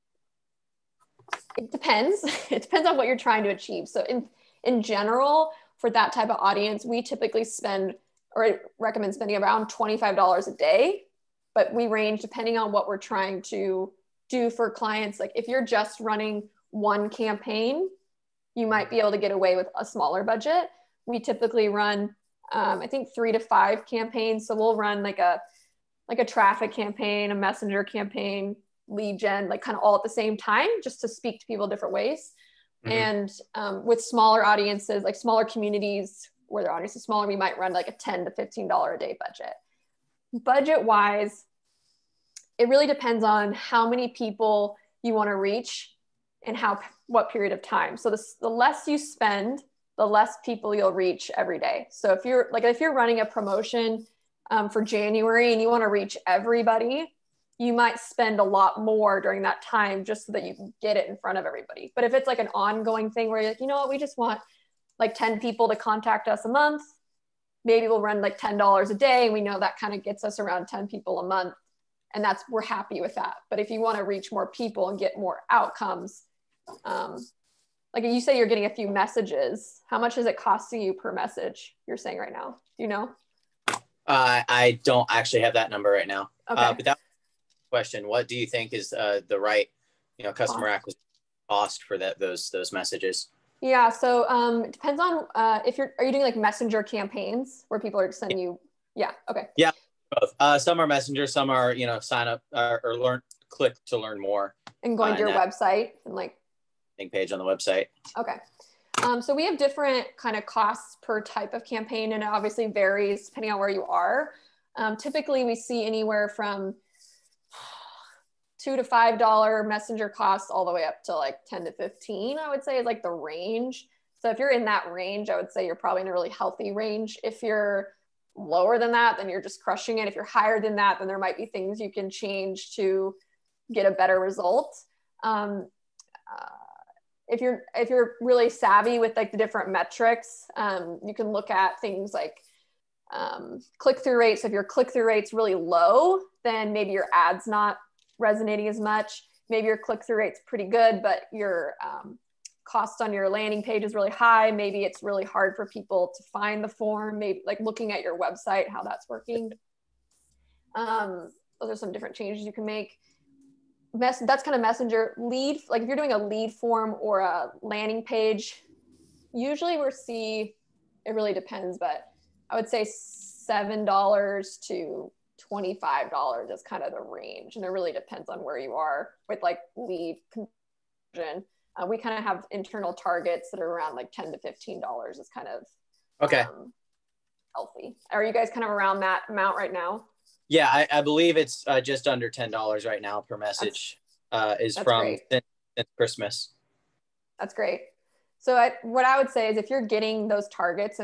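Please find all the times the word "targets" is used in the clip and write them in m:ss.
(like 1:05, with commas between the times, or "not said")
3:02, 3:20.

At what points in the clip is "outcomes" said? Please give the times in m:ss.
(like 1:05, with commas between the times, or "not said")
1:15.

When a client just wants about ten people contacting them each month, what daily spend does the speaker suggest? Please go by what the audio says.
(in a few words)
$10 a day.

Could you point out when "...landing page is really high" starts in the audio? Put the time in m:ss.
2:33.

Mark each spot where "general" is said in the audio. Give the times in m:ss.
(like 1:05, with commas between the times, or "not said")
0:04.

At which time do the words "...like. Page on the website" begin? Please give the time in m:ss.
1:46.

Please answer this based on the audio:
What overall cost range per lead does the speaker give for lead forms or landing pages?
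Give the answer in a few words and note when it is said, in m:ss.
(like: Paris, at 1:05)
$7 to $25, at 2:52.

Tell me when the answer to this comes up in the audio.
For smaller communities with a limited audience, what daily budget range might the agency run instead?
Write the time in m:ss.
0:37.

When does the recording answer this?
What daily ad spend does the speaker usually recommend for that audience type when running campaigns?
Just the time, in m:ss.
0:09.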